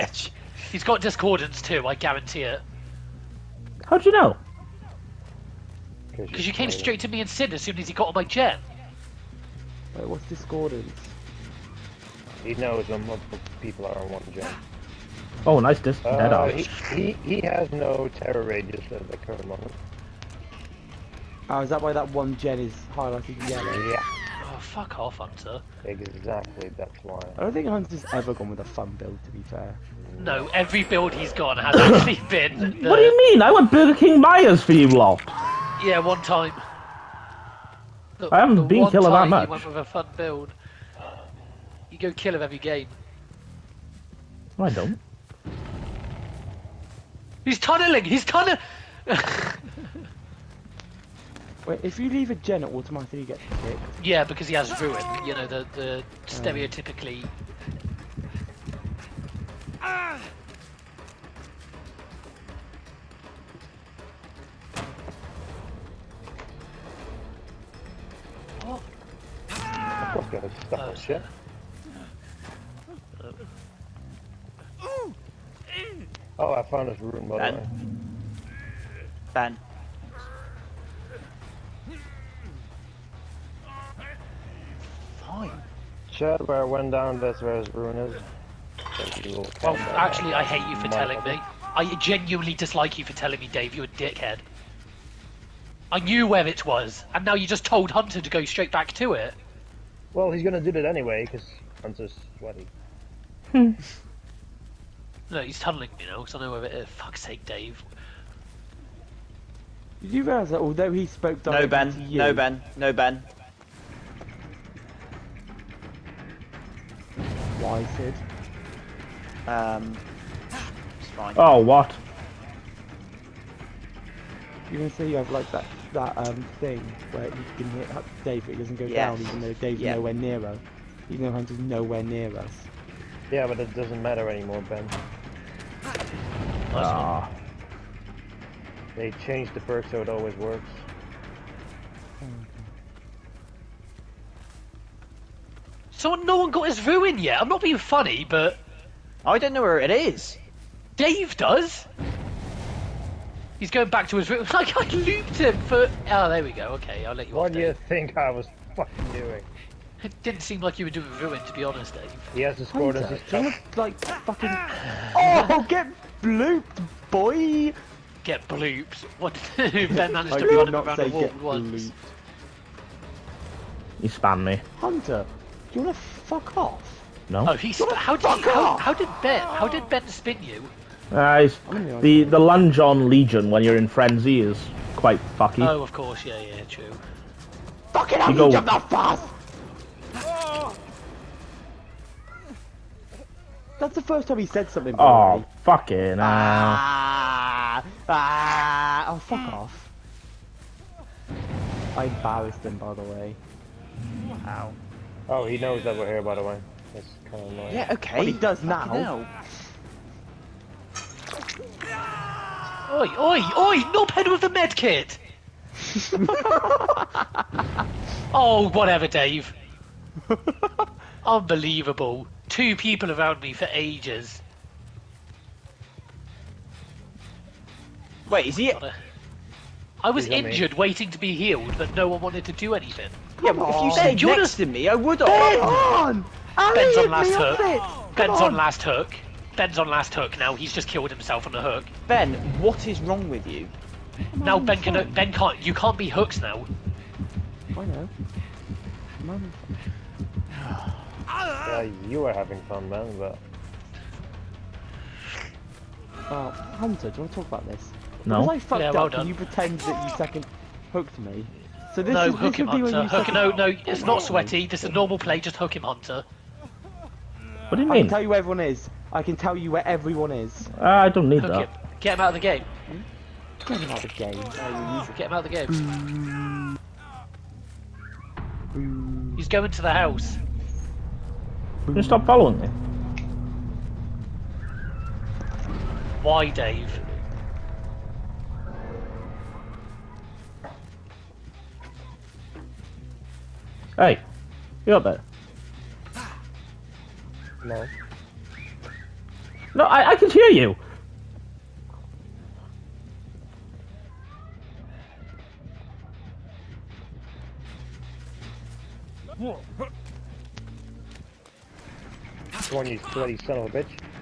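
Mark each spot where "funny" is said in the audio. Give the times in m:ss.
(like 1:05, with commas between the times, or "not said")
2:27.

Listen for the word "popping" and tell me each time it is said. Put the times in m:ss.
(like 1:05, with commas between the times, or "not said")
not said.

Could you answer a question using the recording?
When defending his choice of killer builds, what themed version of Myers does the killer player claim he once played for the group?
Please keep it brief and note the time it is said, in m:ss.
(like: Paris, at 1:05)
Burger King Myers, at 0:33.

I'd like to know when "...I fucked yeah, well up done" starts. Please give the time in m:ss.
4:18.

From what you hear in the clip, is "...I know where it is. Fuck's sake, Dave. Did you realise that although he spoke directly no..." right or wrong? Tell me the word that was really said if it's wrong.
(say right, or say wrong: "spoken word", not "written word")
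right.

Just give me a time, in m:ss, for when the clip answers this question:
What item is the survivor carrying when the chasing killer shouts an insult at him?
3:34.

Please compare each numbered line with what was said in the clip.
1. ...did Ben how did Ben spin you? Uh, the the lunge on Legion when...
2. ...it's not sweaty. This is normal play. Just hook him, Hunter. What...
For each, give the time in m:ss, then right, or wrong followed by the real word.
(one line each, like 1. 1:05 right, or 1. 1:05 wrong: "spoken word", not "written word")
1. 2:58 right
2. 4:23 right.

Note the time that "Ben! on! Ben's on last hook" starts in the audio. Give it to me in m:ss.
3:55.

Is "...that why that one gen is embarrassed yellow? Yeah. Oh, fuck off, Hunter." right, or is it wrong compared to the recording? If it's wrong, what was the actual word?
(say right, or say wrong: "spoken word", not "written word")
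wrong: "highlighted", not "embarrassed".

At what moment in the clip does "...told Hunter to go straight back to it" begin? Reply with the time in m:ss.
1:37.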